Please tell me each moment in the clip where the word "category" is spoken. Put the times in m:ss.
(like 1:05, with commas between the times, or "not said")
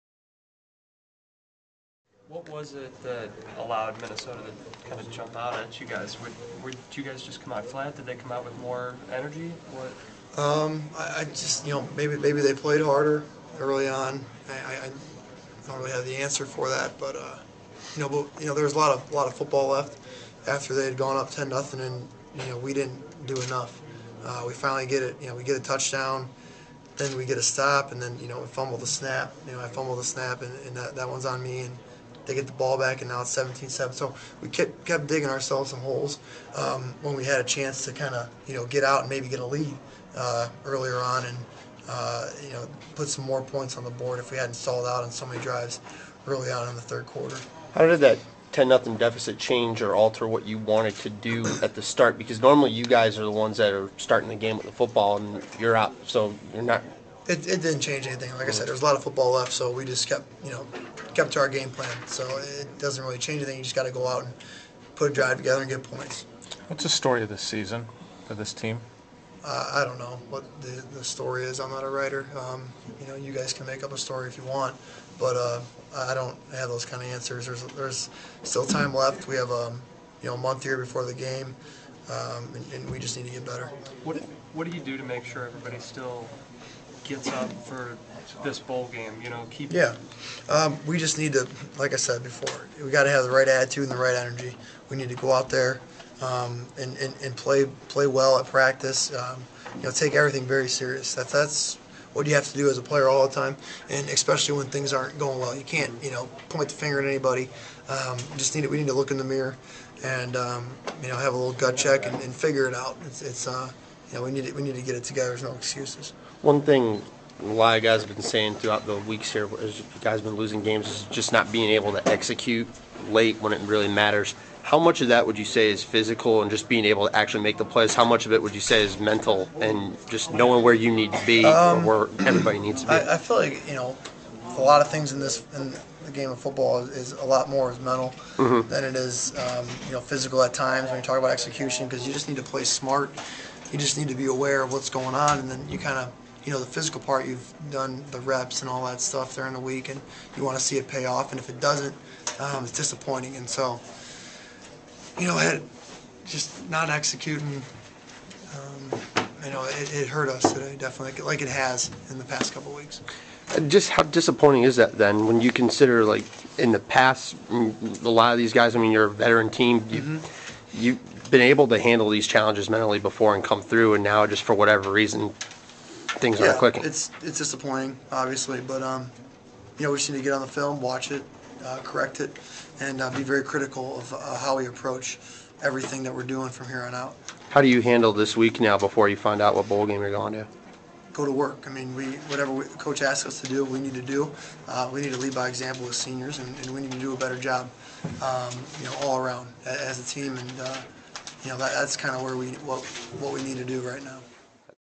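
not said.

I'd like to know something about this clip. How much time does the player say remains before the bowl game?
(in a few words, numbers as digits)
a month.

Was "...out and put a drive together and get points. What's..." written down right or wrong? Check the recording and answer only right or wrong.
right.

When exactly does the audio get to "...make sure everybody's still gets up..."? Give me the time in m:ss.
1:25.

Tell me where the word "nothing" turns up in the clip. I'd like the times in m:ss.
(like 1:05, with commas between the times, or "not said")
0:21, 0:48.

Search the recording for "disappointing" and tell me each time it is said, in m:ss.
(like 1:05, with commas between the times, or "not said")
2:32, 2:44, 2:57.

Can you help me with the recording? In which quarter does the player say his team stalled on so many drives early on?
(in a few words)
third quarter.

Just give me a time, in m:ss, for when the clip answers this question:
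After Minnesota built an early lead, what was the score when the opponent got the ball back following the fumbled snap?
0:33.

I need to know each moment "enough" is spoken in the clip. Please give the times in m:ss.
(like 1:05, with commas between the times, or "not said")
0:23.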